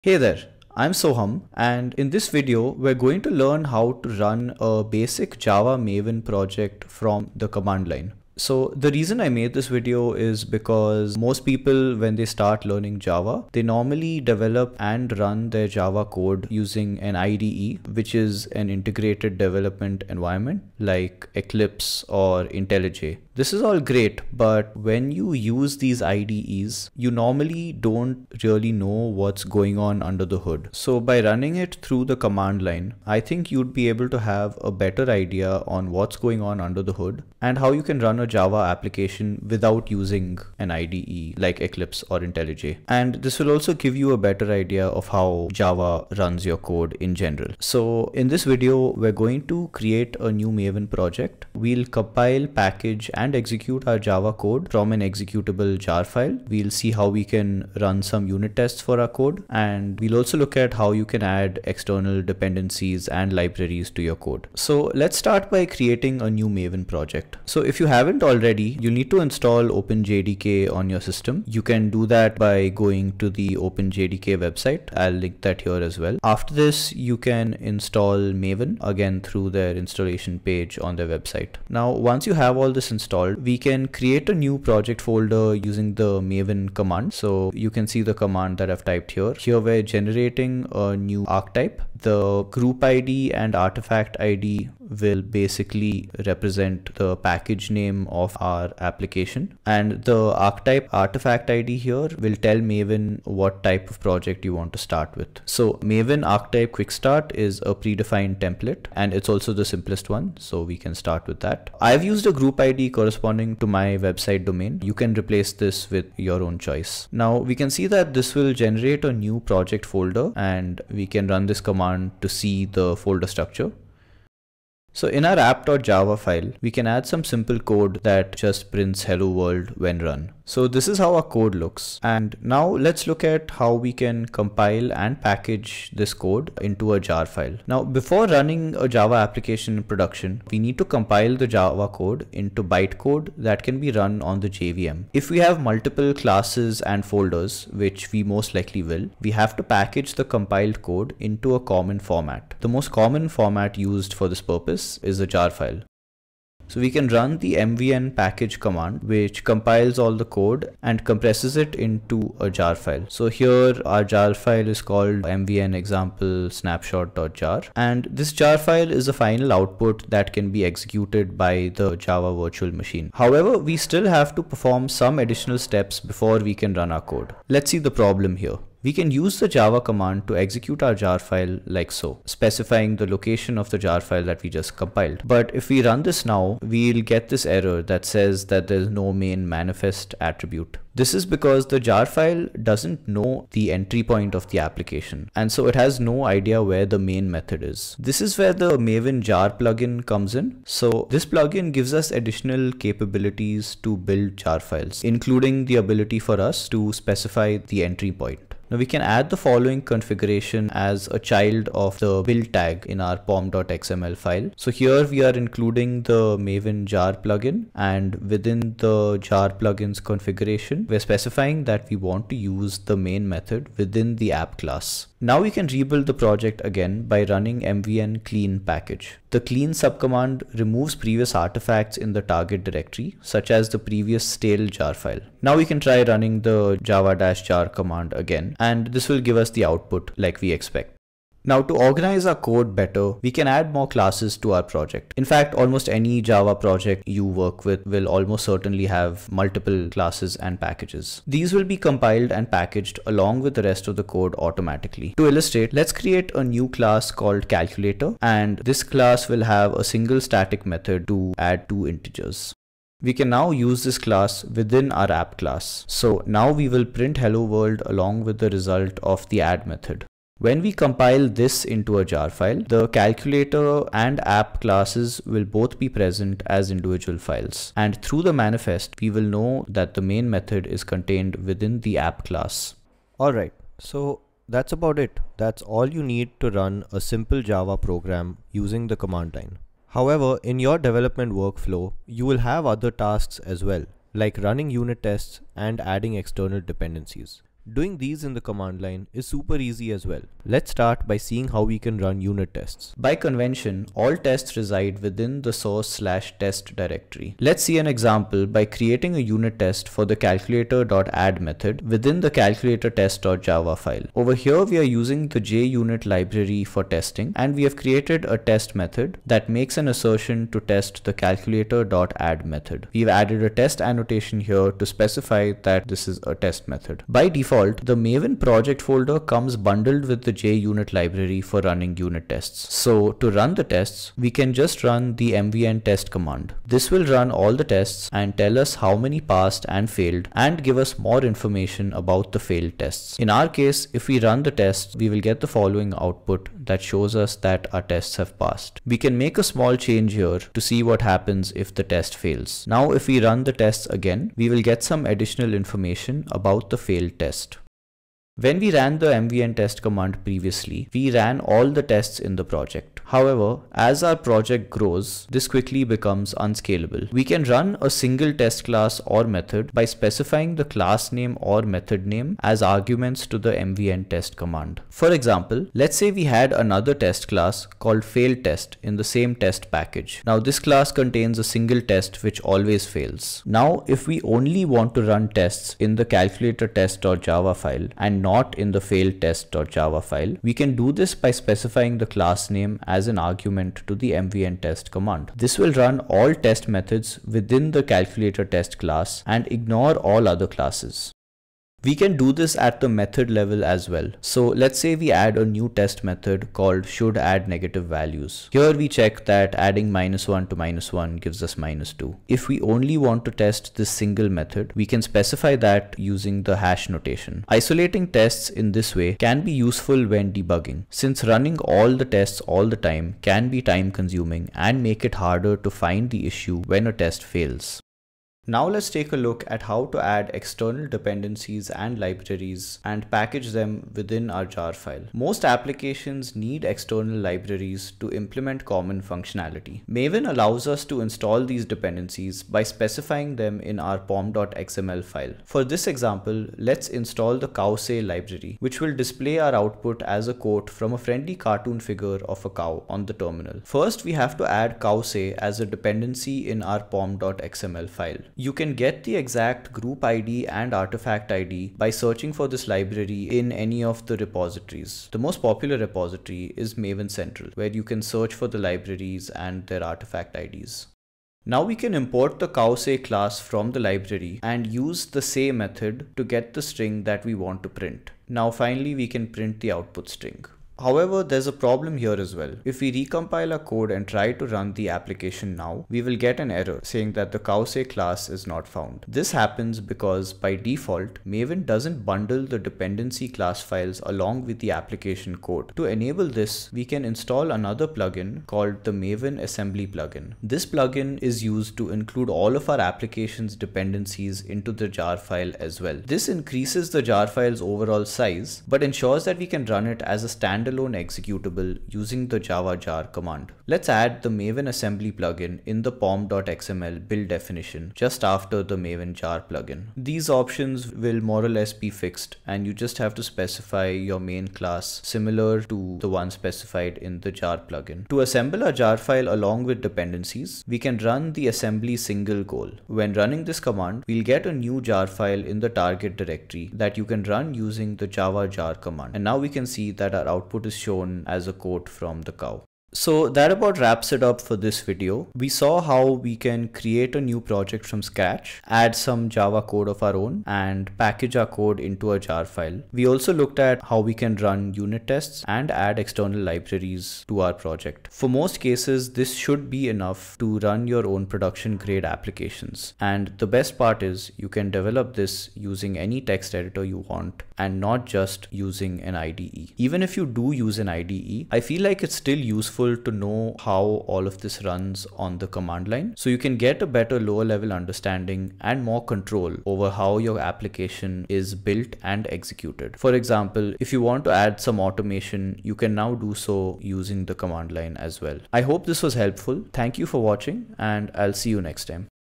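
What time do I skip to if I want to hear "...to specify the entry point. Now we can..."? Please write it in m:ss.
3:26.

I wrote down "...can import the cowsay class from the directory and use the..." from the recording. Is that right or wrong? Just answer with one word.
wrong.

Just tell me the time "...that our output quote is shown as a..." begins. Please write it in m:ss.
8:59.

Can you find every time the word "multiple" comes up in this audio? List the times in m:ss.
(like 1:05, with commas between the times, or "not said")
2:25, 4:09.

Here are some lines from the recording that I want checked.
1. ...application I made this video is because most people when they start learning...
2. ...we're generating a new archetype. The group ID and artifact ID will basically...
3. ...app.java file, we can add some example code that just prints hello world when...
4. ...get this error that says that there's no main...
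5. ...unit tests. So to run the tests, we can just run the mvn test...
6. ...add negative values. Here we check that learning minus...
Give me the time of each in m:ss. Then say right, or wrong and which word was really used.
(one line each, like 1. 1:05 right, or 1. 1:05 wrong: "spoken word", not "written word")
1. 0:08 wrong: "reason", not "application"
2. 1:29 right
3. 2:05 wrong: "simple", not "example"
4. 3:07 right
5. 5:31 right
6. 6:47 wrong: "adding", not "learning".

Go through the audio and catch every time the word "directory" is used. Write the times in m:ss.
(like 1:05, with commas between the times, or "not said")
3:52, 5:06, 8:56.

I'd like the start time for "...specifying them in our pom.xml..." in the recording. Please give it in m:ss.
7:22.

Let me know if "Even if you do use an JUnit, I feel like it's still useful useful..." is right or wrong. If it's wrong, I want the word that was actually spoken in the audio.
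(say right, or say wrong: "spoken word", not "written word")
wrong: "IDE", not "JUnit".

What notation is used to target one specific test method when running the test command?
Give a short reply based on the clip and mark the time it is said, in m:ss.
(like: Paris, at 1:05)
hash notation, at 6:56.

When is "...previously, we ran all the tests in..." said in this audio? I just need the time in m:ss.
6:00.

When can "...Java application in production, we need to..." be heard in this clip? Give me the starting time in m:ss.
2:18.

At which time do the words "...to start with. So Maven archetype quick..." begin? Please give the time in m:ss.
1:44.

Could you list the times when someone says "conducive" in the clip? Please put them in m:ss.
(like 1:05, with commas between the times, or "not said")
not said.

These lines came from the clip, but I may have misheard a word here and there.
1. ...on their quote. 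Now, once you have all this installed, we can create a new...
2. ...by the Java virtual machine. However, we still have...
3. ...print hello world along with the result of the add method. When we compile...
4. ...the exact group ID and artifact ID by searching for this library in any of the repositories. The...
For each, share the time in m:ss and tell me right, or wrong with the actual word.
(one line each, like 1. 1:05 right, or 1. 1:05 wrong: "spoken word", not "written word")
1. 1:20 wrong: "website", not "quote"
2. 2:51 right
3. 4:26 right
4. 7:39 right.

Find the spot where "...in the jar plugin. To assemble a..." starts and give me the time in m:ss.
8:46.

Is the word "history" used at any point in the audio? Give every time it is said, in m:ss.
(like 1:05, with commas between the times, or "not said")
not said.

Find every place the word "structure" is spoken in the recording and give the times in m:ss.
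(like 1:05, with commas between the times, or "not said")
2:03.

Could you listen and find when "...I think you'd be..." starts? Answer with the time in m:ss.
0:33.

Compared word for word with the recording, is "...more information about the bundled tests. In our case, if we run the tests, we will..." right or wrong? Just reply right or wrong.
wrong.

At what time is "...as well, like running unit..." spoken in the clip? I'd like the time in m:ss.
4:53.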